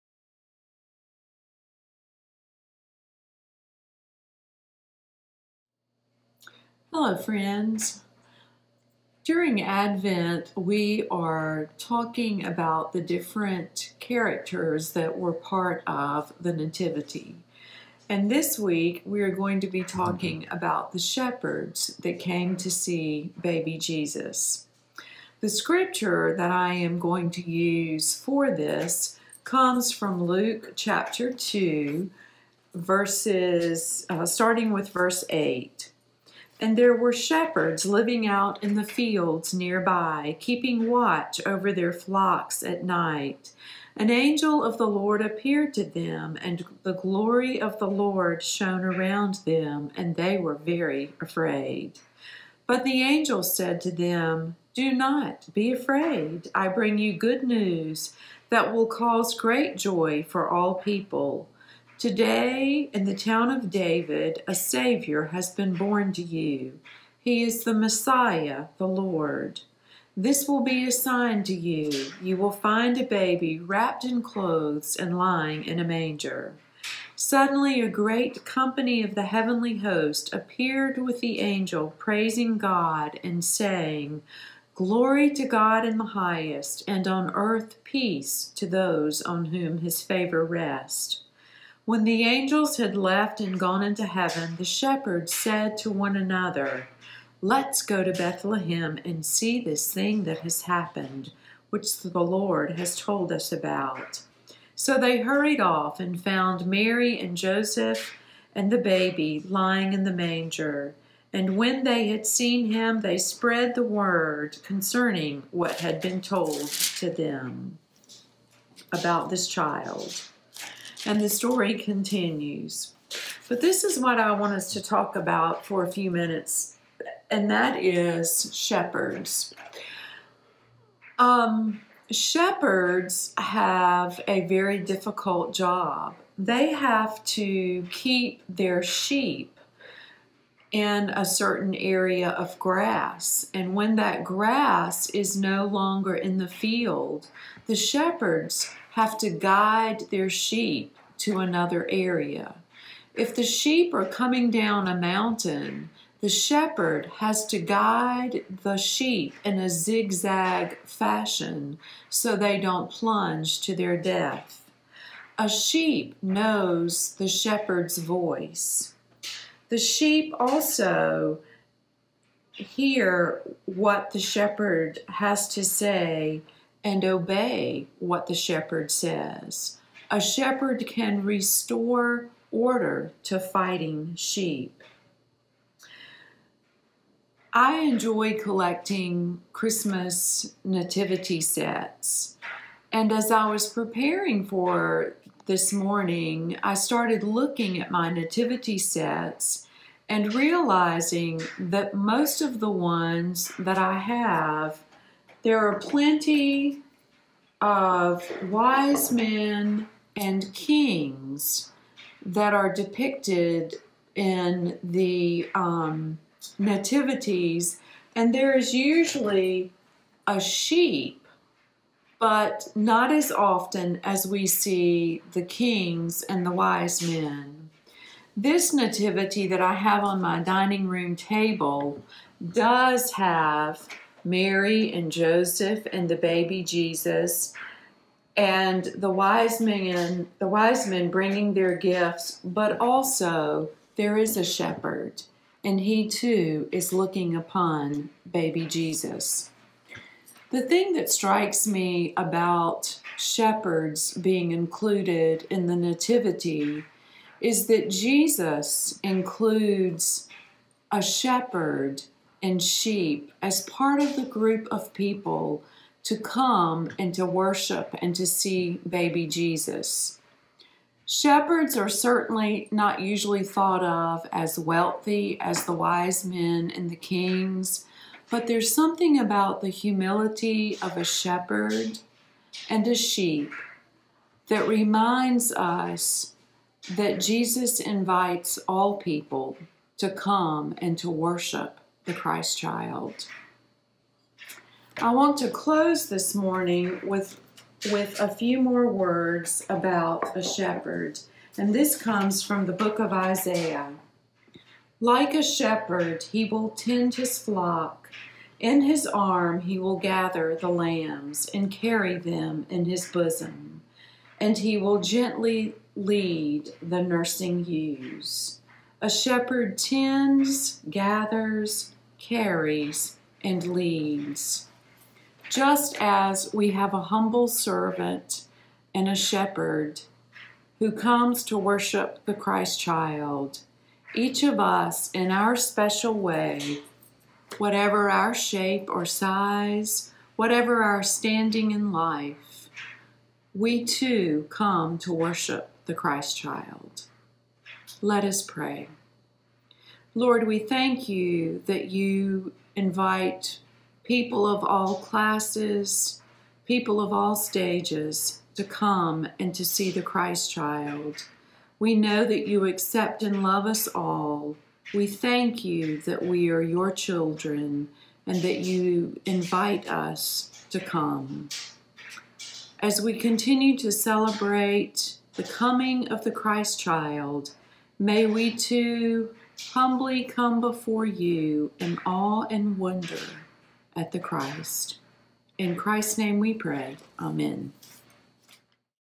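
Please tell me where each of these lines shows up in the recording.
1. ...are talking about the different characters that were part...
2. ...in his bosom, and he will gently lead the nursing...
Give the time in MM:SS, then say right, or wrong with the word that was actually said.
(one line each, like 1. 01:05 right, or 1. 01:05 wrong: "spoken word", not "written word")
1. 00:11 right
2. 05:12 right.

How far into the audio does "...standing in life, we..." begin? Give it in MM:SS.
05:41.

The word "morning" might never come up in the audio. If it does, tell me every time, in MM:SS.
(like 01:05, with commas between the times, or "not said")
03:15, 04:56.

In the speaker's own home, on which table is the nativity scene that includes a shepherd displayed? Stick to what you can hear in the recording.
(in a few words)
dining room table.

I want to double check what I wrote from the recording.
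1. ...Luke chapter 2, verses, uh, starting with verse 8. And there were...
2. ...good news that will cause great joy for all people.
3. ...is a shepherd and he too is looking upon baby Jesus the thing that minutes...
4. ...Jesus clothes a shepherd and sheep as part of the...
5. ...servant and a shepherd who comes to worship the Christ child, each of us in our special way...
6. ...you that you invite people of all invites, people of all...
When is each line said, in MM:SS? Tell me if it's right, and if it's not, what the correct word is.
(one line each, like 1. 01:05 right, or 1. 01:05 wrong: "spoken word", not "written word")
1. 00:30 right
2. 00:57 right
3. 04:04 wrong: "strikes", not "minutes"
4. 04:17 wrong: "includes", not "clothes"
5. 05:27 right
6. 05:51 wrong: "classes", not "invites".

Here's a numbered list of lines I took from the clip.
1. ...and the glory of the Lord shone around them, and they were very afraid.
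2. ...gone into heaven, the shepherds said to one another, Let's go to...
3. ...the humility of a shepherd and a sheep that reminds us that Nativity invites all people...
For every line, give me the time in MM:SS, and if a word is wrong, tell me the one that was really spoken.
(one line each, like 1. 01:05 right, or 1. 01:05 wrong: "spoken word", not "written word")
1. 00:46 right
2. 01:33 right
3. 04:39 wrong: "Jesus", not "Nativity".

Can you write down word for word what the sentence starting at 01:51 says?
And when they had seen him, they spread the word concerning what had been told to them about this child.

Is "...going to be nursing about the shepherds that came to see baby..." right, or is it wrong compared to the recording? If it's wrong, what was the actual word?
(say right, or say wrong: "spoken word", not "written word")
wrong: "talking", not "nursing".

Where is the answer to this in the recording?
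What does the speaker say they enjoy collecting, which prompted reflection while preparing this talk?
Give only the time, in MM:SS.
03:09.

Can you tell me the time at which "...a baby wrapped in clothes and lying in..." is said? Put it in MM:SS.
01:12.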